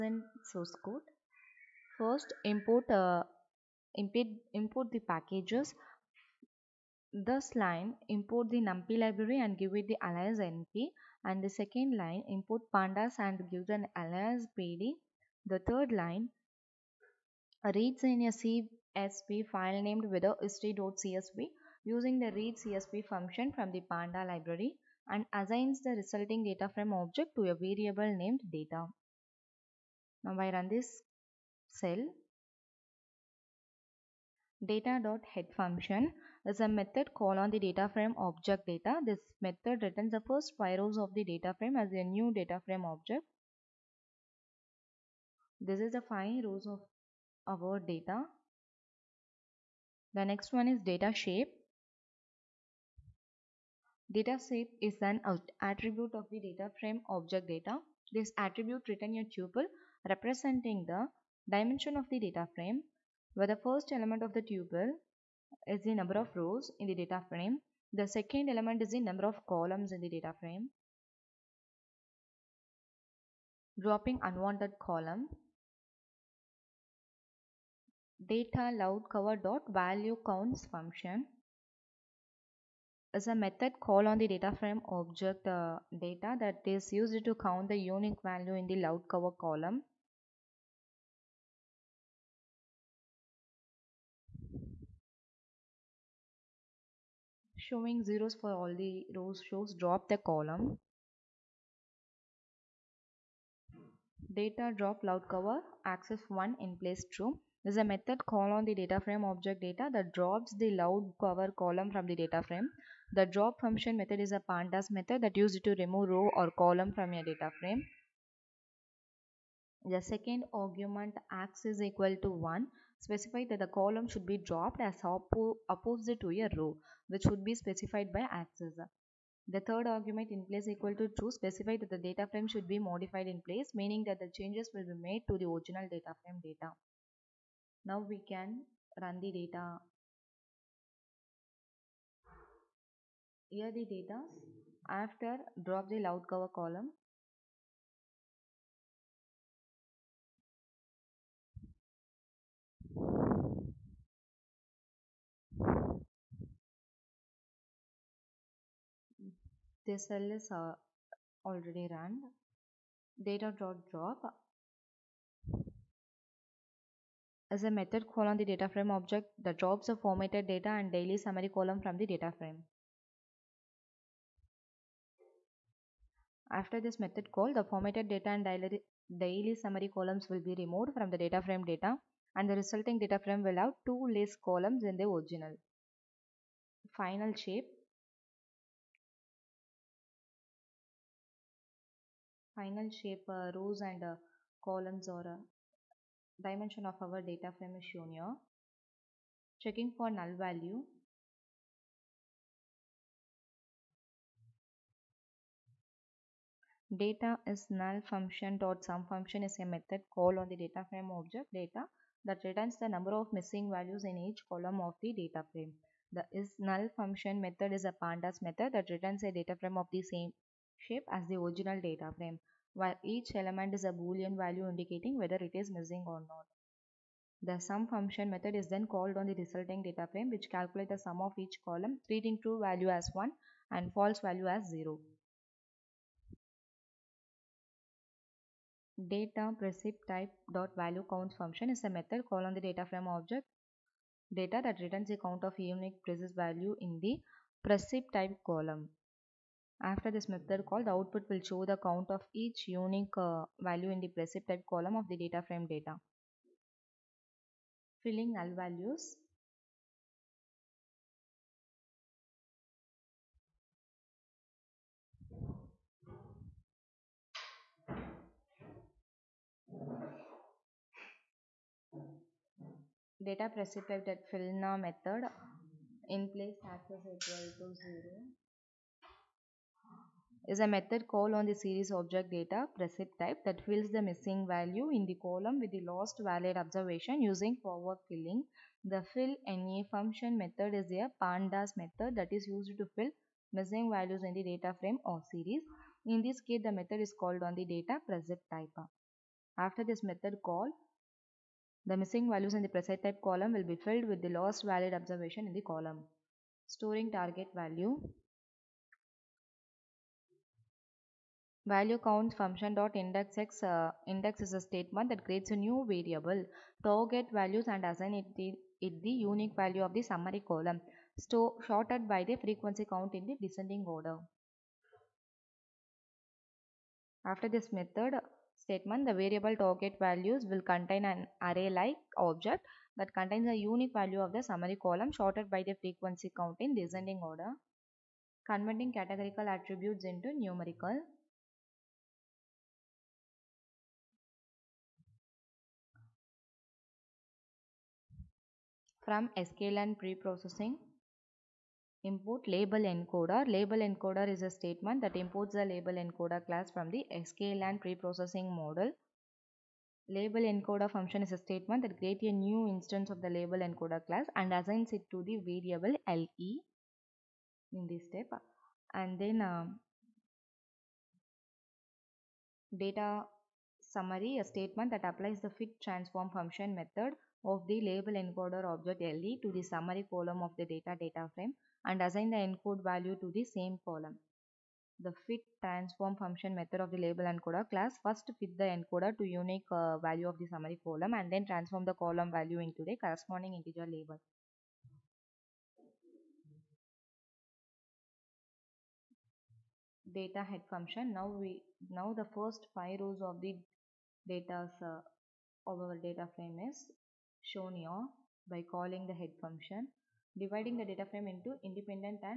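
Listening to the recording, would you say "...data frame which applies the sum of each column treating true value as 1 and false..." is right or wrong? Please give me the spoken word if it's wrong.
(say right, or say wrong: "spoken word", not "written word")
wrong: "calculates", not "applies".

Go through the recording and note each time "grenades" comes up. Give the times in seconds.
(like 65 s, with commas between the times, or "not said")
not said.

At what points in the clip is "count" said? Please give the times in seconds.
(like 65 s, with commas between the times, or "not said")
80 s, 87 s, 241 s, 245 s, 251 s, 311 s, 322 s, 336 s.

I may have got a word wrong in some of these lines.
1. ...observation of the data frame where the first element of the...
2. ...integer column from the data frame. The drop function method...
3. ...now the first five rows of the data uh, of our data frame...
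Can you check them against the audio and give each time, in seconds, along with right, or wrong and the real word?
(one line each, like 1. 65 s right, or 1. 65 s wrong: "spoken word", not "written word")
1. 61 s wrong: "dimension", not "observation"
2. 111 s wrong: "cover", not "integer"
3. 401 s right.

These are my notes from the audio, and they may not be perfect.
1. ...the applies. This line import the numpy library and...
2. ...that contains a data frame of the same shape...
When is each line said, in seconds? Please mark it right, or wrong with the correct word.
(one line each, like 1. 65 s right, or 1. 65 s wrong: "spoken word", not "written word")
1. 4 s wrong: "packages", not "applies"
2. 218 s wrong: "returns", not "contains".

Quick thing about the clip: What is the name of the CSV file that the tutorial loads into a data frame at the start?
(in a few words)
history.csv.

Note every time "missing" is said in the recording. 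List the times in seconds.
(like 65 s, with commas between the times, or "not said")
213 s, 225 s, 284 s, 293 s, 301 s.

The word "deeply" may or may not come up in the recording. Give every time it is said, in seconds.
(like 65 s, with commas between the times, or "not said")
not said.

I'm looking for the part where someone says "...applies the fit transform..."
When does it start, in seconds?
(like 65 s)
375 s.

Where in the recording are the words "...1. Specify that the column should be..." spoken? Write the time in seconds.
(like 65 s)
122 s.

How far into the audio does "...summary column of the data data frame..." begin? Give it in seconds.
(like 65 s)
379 s.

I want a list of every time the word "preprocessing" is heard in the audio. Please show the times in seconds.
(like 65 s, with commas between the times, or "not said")
350 s, 357 s.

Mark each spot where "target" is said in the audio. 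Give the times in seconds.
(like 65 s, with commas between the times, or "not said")
307 s, 316 s, 329 s.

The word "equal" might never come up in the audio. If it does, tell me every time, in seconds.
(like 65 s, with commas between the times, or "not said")
121 s, 130 s, 277 s.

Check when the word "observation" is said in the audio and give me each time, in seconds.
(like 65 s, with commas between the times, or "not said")
286 s, 304 s.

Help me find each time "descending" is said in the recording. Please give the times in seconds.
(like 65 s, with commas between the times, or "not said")
323 s, 336 s.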